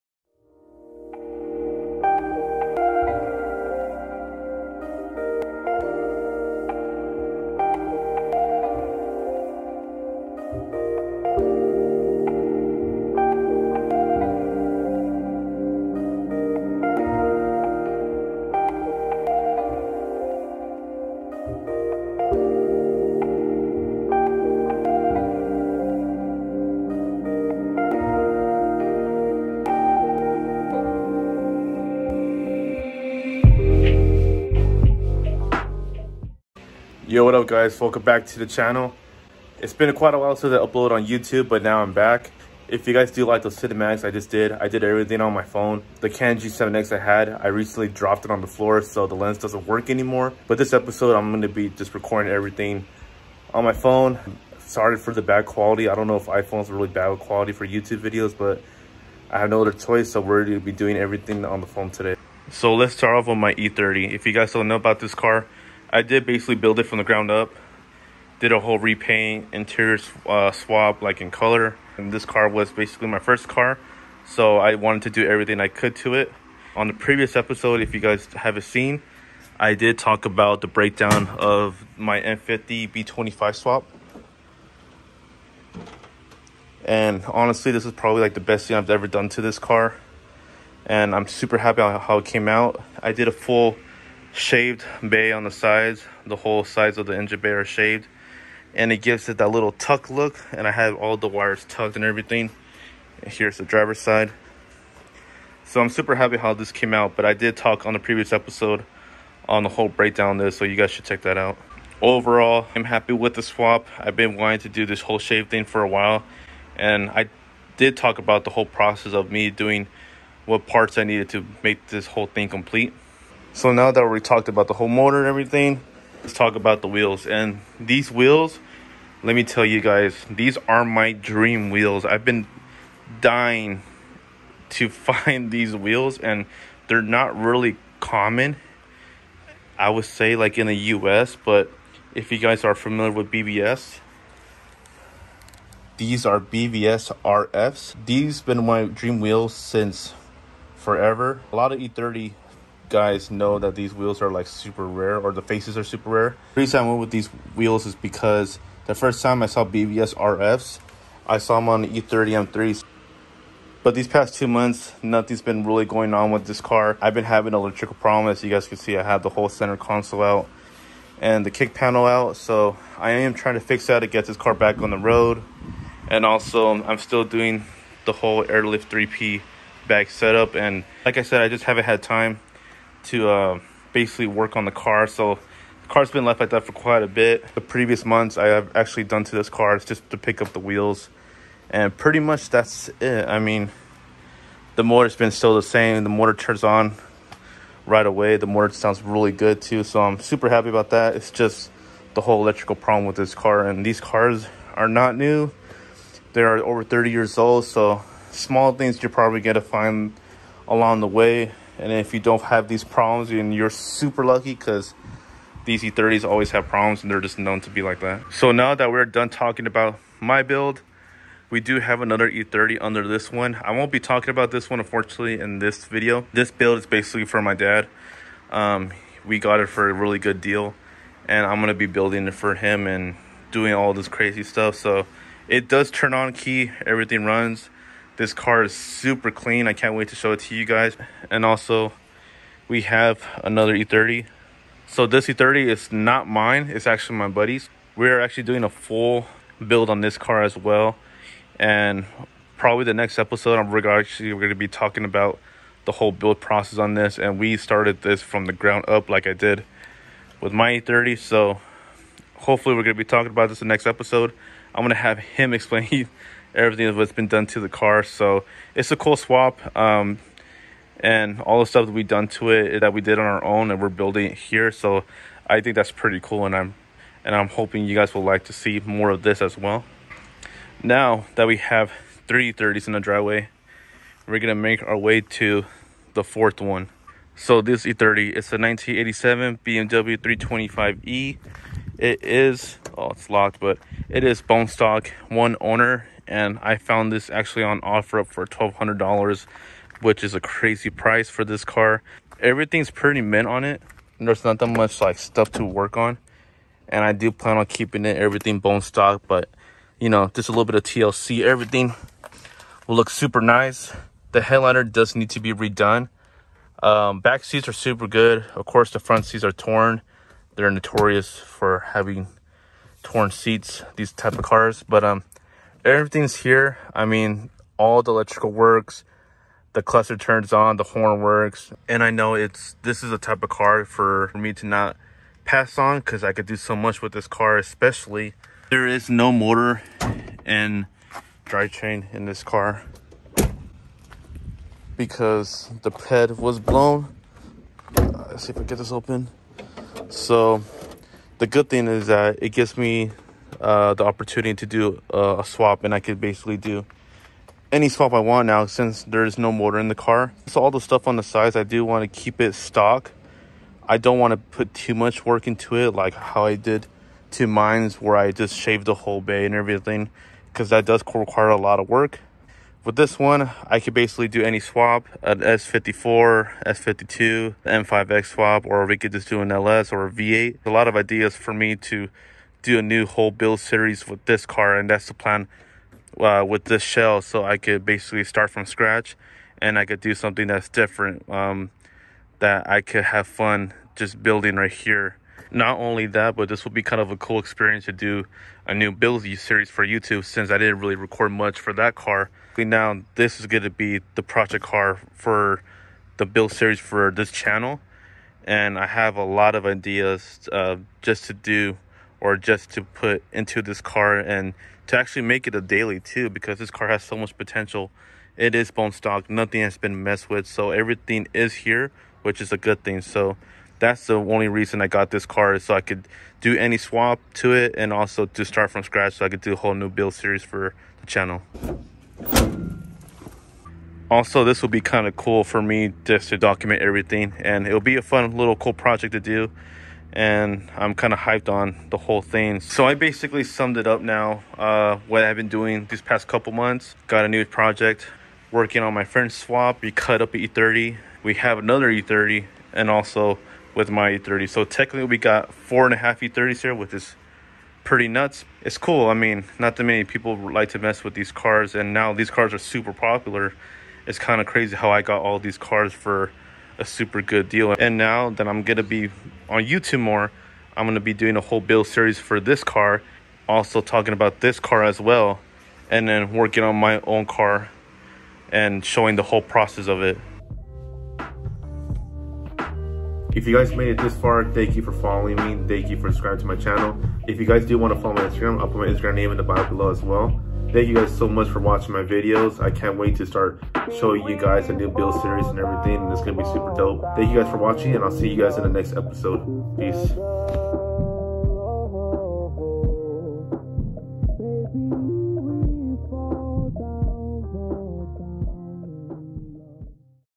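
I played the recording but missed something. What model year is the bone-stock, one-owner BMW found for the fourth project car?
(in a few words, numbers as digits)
1987.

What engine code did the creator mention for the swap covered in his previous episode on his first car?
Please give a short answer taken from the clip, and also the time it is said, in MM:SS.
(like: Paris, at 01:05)
M50 B25, at 01:22.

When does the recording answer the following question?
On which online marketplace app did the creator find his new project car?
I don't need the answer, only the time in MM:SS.
04:57.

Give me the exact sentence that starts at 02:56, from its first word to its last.
And also, I'm still doing the whole airlift 3P bag setup.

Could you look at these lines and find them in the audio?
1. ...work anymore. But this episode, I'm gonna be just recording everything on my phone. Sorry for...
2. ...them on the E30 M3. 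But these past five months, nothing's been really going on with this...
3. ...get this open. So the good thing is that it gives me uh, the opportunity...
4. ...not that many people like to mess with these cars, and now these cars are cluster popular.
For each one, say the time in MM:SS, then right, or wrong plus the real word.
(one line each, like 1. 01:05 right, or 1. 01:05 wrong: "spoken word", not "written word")
1. 00:49 right
2. 02:41 wrong: "two", not "five"
3. 05:48 right
4. 07:39 wrong: "super", not "cluster".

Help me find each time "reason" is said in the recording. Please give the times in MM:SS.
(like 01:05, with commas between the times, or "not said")
02:36, 07:04.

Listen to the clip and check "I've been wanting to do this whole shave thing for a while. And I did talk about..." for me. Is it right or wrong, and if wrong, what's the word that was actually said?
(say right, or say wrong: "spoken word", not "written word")
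right.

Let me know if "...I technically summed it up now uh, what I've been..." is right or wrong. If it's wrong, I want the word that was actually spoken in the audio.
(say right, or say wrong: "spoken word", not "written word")
wrong: "basically", not "technically".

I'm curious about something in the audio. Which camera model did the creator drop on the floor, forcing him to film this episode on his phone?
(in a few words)
Canon G7X.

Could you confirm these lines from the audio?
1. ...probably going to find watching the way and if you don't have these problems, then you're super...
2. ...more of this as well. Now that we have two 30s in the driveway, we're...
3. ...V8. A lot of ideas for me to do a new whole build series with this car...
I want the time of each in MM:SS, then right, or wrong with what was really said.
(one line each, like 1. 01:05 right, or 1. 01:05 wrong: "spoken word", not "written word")
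1. 03:29 wrong: "along", not "watching"
2. 04:38 wrong: "three", not "two"
3. 06:20 right.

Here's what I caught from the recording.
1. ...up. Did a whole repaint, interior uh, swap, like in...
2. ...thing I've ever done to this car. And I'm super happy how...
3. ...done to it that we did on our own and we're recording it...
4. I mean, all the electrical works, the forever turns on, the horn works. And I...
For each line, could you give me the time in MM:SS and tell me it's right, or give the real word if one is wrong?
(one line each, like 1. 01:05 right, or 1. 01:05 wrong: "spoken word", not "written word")
1. 01:07 right
2. 01:28 right
3. 04:32 wrong: "building", not "recording"
4. 05:26 wrong: "cluster", not "forever".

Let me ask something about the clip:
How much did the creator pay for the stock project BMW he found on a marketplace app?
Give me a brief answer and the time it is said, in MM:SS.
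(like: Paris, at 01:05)
$1,200, at 04:58.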